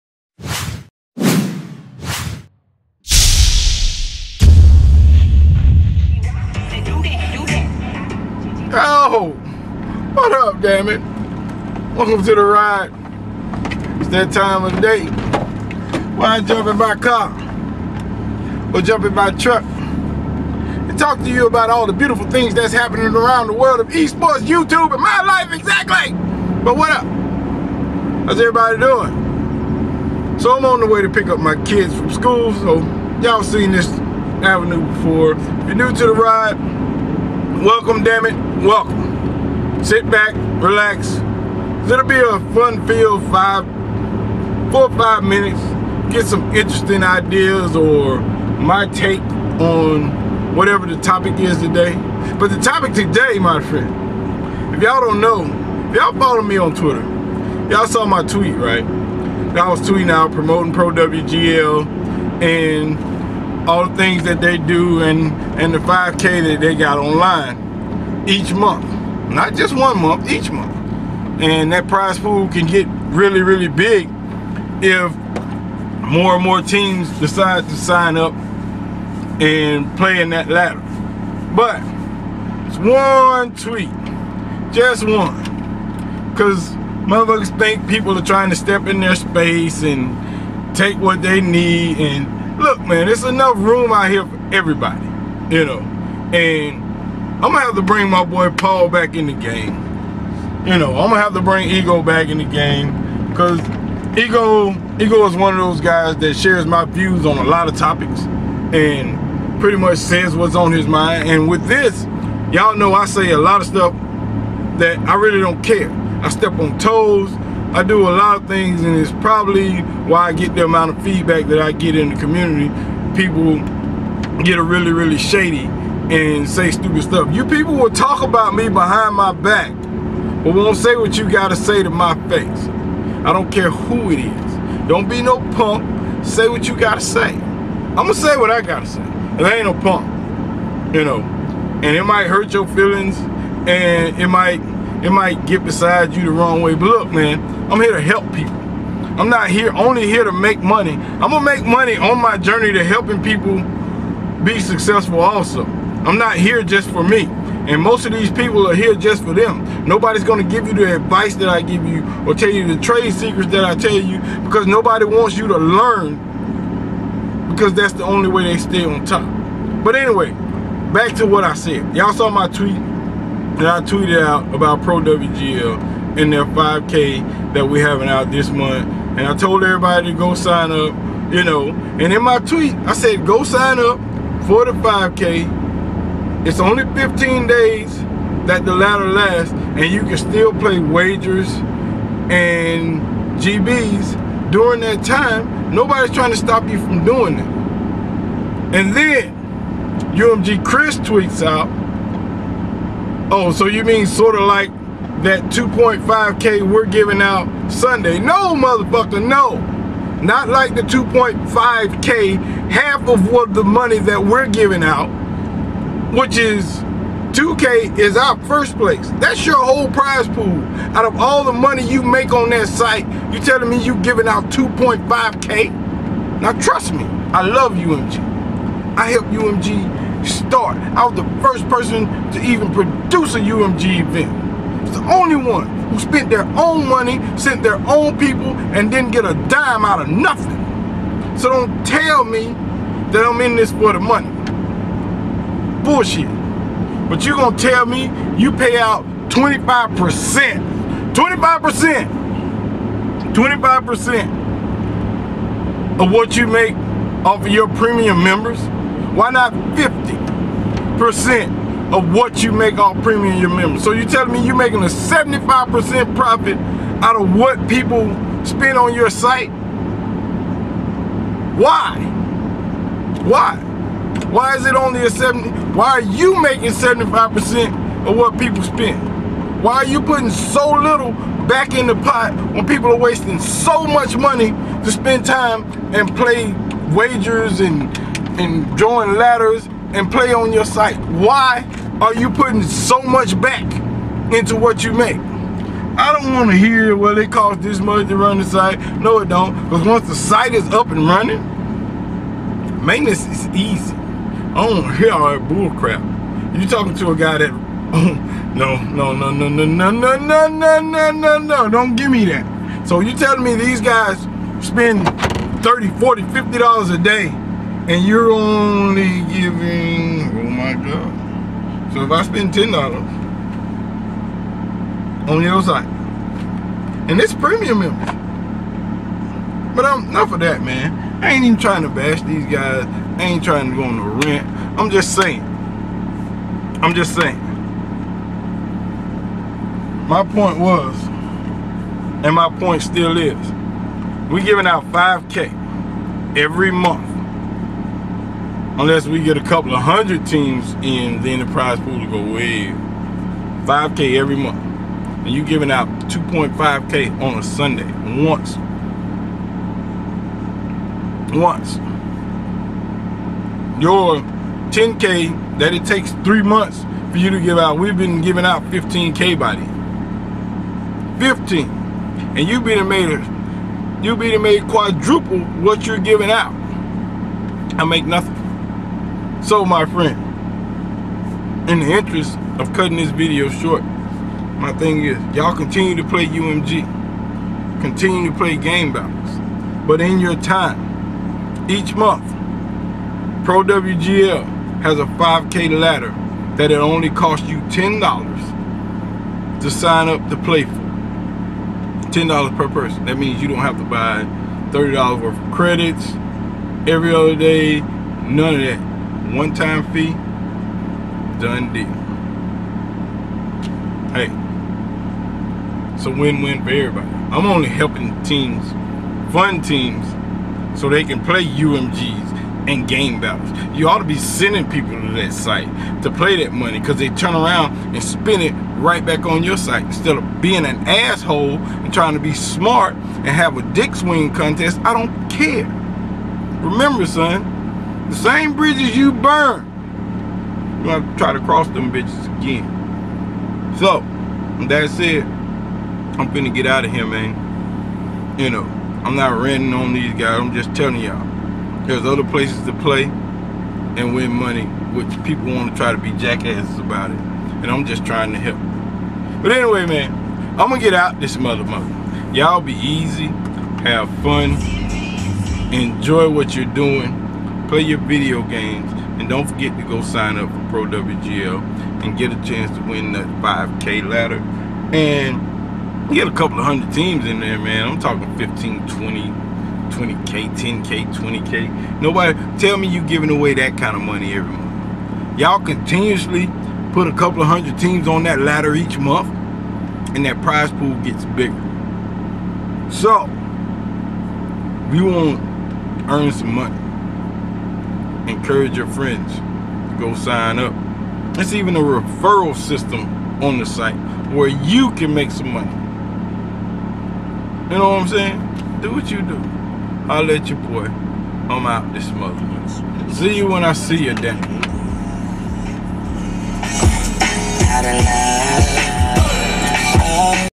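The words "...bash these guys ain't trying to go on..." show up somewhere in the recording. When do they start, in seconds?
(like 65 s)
331 s.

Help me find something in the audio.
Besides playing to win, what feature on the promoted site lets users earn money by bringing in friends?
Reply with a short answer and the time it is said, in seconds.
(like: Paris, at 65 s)
referral system, at 501 s.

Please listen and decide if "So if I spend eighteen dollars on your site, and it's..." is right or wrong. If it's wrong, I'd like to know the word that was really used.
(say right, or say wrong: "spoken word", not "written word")
wrong: "ten", not "eighteen".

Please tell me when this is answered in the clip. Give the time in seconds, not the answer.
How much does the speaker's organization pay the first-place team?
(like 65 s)
217 s.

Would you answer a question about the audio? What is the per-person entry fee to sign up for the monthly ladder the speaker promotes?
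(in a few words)
$10.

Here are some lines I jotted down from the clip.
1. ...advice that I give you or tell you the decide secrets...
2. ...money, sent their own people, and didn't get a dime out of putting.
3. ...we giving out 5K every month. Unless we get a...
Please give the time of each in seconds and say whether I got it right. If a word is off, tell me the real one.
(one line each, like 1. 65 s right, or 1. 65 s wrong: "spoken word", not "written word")
1. 160 s wrong: "trade", not "decide"
2. 236 s wrong: "nothing", not "putting"
3. 344 s right.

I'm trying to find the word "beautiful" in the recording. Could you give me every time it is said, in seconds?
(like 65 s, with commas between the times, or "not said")
21 s.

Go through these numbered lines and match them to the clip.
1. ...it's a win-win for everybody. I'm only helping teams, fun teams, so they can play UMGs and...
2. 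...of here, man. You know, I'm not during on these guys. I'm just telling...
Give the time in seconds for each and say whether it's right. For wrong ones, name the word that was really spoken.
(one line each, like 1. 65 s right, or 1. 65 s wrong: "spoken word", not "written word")
1. 415 s right
2. 446 s wrong: "ranting", not "during".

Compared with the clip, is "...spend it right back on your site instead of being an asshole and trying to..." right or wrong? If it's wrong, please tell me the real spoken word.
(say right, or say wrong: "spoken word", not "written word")
right.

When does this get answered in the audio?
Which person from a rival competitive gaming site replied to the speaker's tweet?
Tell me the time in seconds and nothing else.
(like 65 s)
200 s.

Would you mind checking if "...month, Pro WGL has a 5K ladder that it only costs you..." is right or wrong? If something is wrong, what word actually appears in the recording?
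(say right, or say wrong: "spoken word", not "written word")
right.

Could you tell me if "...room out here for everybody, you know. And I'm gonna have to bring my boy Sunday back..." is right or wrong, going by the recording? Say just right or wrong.
wrong.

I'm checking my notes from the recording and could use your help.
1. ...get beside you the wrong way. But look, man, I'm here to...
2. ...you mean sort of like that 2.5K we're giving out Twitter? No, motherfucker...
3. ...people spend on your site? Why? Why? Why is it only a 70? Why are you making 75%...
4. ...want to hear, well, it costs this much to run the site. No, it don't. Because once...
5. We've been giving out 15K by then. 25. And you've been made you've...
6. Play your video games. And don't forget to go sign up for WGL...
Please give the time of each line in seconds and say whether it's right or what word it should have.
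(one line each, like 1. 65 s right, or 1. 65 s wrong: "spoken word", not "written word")
1. 145 s right
2. 203 s wrong: "Sunday", not "Twitter"
3. 267 s right
4. 296 s right
5. 367 s wrong: "15", not "25"
6. 467 s wrong: "Pro", not "WGL".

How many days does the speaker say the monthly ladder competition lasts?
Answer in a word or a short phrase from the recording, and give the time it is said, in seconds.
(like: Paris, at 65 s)
15, at 186 s.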